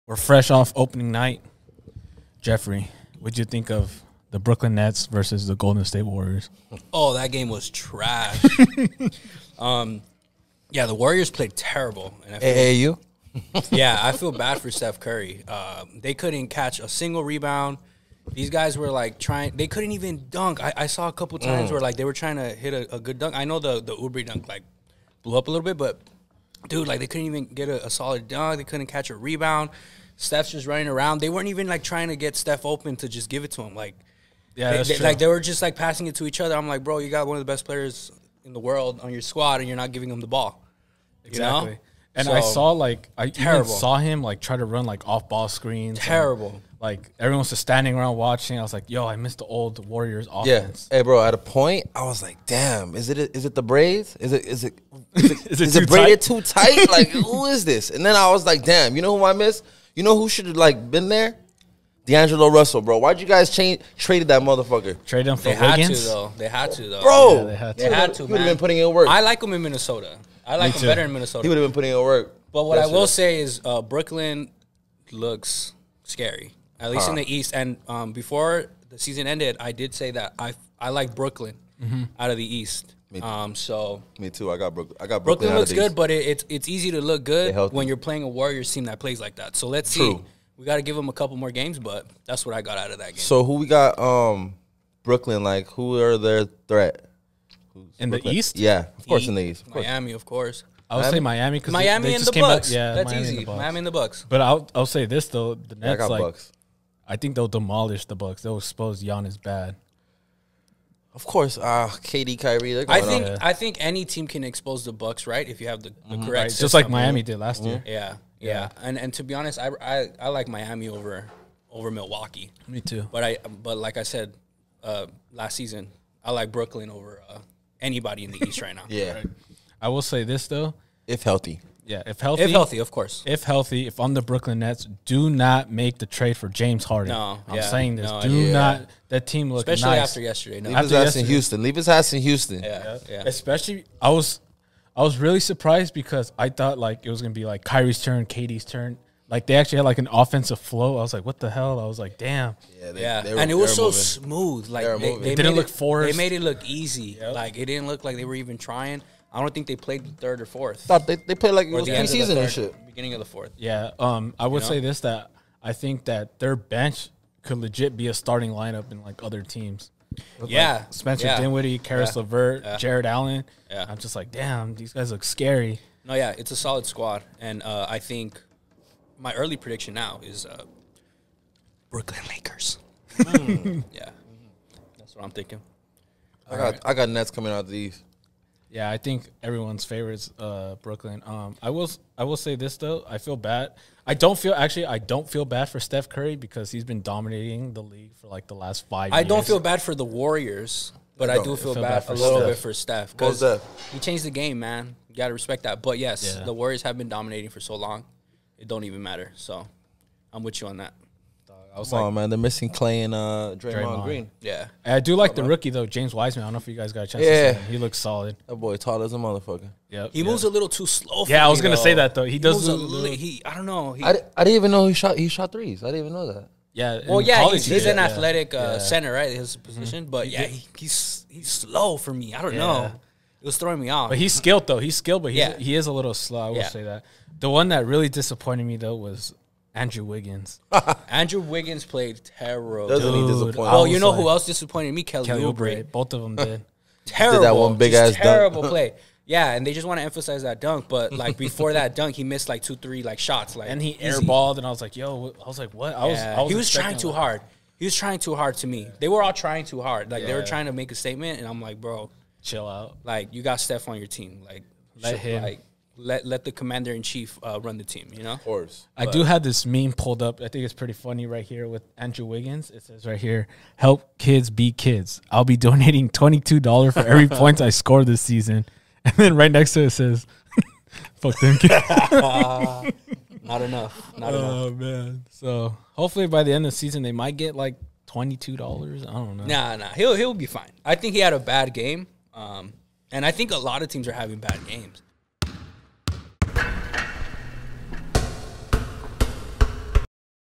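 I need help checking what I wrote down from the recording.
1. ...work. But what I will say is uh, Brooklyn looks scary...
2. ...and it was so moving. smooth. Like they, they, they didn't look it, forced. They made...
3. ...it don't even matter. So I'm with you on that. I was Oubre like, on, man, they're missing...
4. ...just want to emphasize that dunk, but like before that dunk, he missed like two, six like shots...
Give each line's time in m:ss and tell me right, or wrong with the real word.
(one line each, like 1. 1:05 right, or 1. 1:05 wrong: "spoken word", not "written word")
1. 1:12 right
2. 2:33 right
3. 3:28 wrong: "Come", not "Oubre"
4. 4:09 wrong: "three", not "six".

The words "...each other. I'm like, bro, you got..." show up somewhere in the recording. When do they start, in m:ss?
0:36.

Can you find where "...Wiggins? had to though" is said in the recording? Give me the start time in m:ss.
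1:05.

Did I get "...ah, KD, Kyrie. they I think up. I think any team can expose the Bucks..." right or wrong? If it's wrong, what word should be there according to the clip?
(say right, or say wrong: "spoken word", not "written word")
right.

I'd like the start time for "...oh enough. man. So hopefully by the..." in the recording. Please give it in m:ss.
4:44.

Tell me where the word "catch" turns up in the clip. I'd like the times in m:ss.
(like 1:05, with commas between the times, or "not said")
0:16, 0:28.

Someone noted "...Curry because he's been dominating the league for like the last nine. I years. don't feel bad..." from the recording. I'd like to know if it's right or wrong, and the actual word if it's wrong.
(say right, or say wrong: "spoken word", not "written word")
wrong: "five", not "nine".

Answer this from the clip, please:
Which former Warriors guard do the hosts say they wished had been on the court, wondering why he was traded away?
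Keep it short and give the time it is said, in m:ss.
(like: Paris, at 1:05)
D'Angelo Russell, at 1:02.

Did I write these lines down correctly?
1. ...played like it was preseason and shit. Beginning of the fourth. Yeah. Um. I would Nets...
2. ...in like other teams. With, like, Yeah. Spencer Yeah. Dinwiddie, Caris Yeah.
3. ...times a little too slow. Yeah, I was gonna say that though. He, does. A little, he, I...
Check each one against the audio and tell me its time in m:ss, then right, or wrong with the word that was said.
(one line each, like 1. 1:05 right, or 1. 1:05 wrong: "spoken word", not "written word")
1. 2:41 wrong: "You", not "Nets"
2. 2:48 right
3. 3:40 wrong: "moves", not "times".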